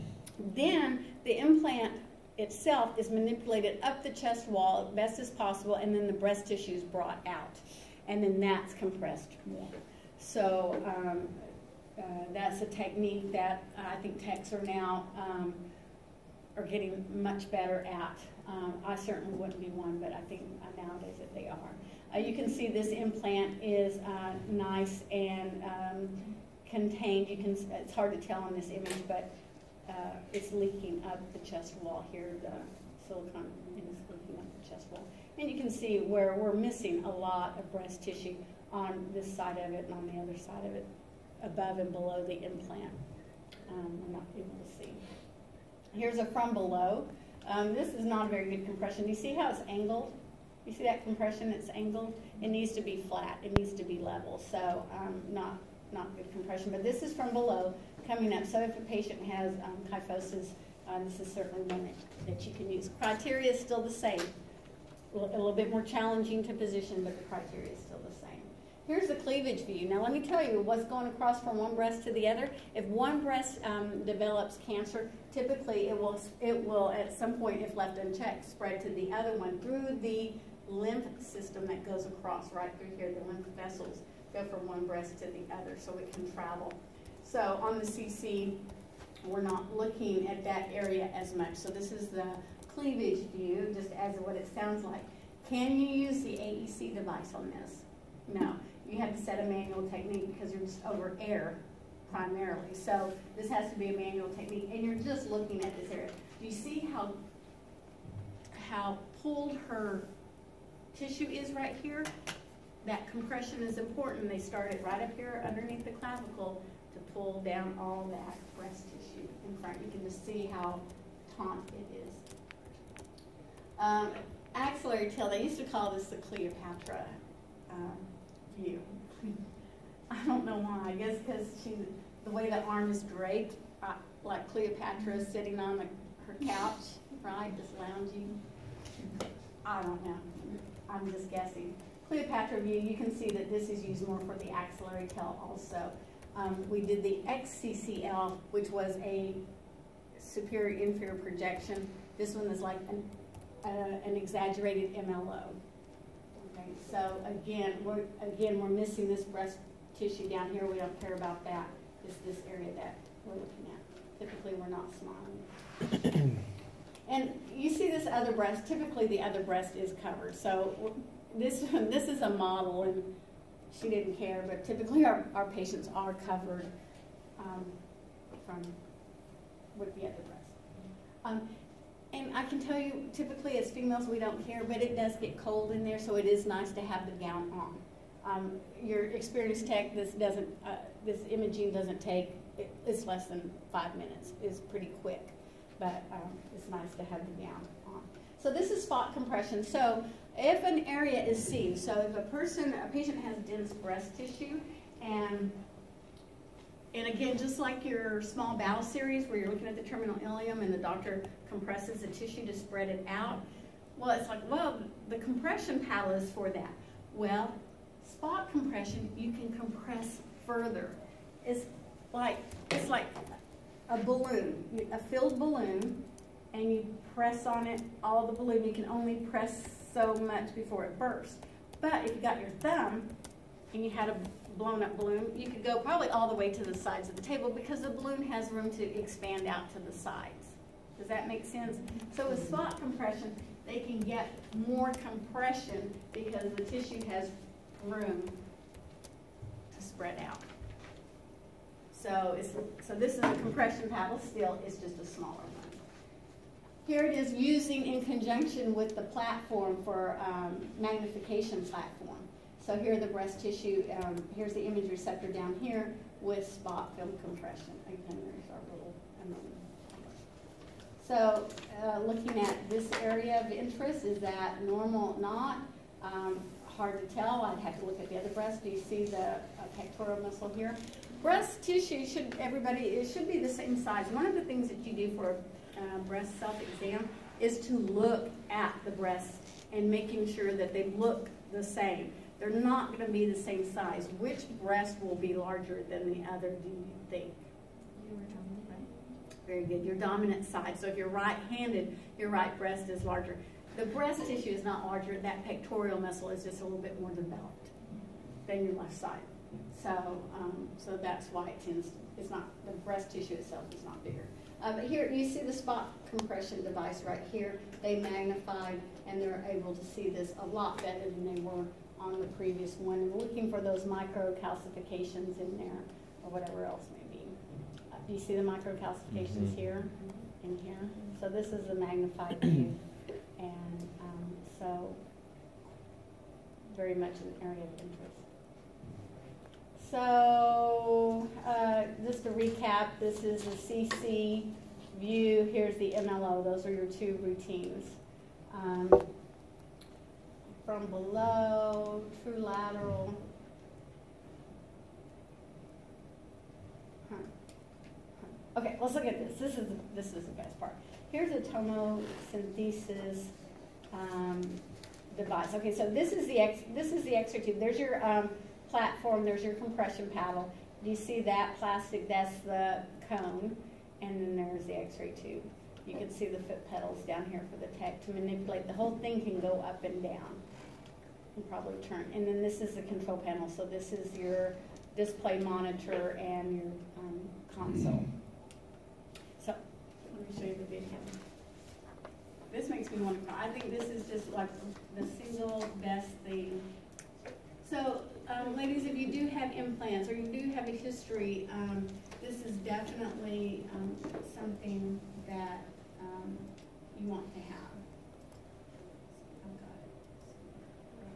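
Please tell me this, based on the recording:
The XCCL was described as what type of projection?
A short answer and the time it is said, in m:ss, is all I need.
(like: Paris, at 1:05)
superior inferior projection, at 2:30.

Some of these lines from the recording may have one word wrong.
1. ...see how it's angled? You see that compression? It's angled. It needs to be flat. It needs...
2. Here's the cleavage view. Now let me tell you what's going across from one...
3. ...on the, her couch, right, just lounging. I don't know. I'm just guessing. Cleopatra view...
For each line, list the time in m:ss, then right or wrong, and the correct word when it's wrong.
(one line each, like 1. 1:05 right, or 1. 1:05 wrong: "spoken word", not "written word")
1. 0:49 right
2. 1:08 right
3. 2:15 right.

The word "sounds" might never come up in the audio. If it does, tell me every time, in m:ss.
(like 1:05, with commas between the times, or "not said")
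1:34.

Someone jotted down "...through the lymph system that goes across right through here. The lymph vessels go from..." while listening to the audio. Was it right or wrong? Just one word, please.
right.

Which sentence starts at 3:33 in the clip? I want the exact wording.
Well, it's like, well, the compression paddle is for that.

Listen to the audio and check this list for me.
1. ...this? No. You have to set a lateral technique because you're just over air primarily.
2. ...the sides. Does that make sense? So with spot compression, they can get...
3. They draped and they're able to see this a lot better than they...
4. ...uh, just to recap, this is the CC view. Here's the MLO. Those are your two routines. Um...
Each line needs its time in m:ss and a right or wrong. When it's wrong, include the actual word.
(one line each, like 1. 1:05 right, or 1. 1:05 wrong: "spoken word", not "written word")
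1. 1:37 wrong: "manual", not "lateral"
2. 3:59 right
3. 5:17 wrong: "magnified", not "draped"
4. 5:41 right.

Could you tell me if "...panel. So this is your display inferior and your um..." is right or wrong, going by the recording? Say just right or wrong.
wrong.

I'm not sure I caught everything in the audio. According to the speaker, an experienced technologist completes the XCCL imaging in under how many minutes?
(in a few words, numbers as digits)
5.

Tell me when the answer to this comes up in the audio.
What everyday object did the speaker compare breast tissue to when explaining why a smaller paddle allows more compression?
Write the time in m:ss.
3:44.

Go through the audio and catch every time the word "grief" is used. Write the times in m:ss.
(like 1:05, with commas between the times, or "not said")
not said.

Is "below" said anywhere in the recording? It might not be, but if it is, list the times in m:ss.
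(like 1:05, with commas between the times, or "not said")
0:41, 0:46, 0:57, 5:50.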